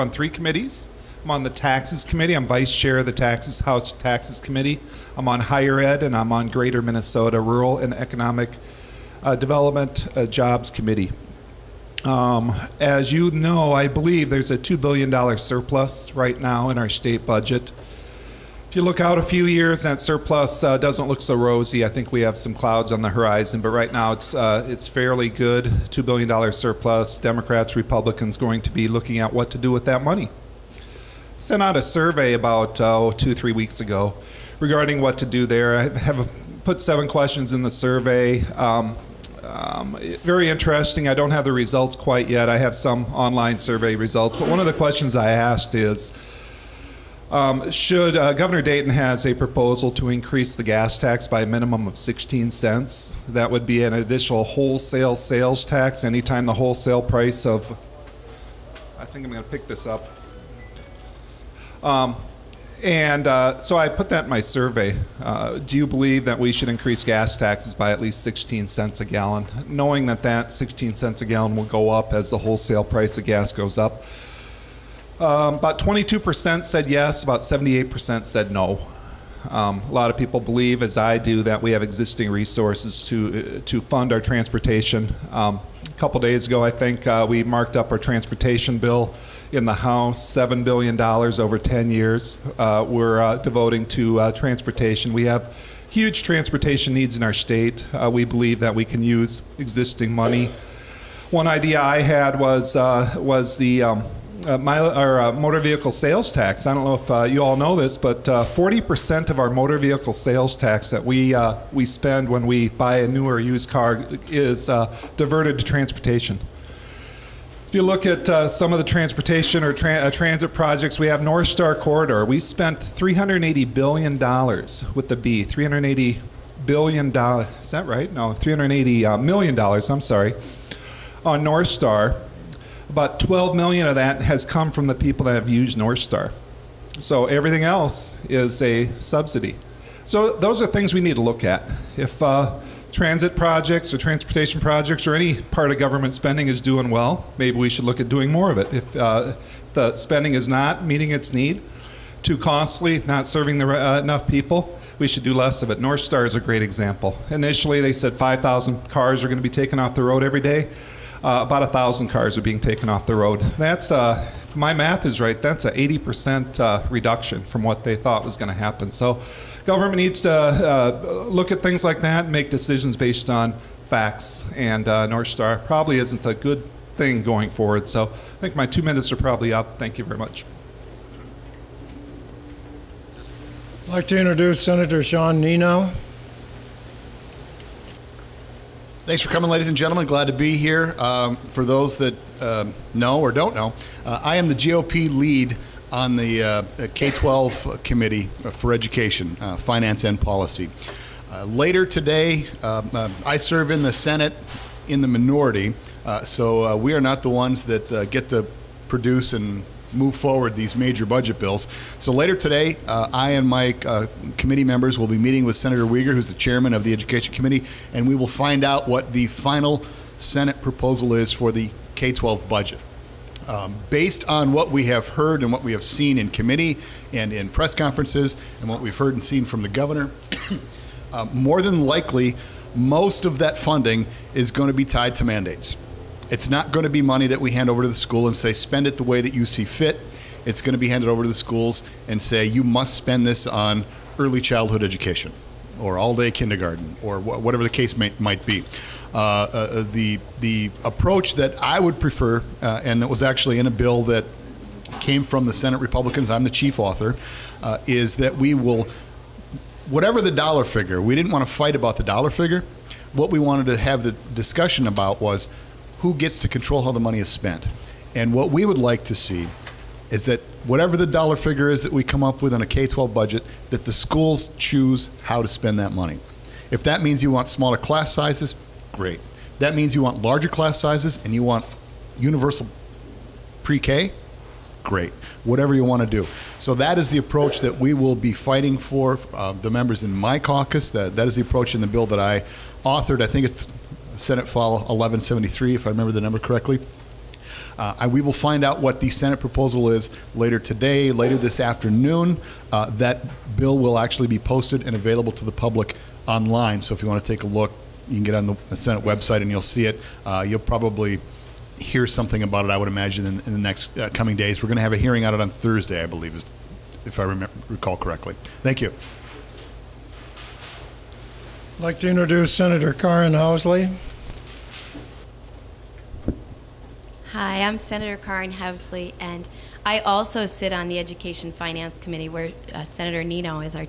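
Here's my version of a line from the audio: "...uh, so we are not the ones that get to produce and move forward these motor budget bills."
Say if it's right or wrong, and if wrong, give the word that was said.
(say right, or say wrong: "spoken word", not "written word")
wrong: "major", not "motor".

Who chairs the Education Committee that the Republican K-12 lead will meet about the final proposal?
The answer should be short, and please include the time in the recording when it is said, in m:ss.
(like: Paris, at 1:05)
Senator Wiger, at 3:35.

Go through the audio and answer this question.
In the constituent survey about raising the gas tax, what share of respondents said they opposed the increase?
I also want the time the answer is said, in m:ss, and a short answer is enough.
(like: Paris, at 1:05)
78%, at 1:17.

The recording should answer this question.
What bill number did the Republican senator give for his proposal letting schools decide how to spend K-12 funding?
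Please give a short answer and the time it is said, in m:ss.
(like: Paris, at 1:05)
Senate File 1173, at 4:54.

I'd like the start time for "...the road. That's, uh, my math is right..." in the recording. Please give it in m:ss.
2:43.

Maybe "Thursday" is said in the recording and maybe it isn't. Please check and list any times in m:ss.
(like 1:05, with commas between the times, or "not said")
5:15.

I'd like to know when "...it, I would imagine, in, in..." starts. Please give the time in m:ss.
5:12.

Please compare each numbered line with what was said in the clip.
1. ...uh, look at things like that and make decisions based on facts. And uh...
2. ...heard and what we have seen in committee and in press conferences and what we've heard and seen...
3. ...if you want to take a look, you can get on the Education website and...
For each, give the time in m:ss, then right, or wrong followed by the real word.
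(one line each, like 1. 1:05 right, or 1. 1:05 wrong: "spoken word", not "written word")
1. 2:50 right
2. 3:45 right
3. 5:06 wrong: "Senate", not "Education".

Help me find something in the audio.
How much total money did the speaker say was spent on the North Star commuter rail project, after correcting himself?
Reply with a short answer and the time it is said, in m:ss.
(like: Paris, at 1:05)
$380 million, at 2:08.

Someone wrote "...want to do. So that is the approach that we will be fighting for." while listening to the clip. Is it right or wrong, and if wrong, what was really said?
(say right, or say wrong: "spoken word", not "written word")
right.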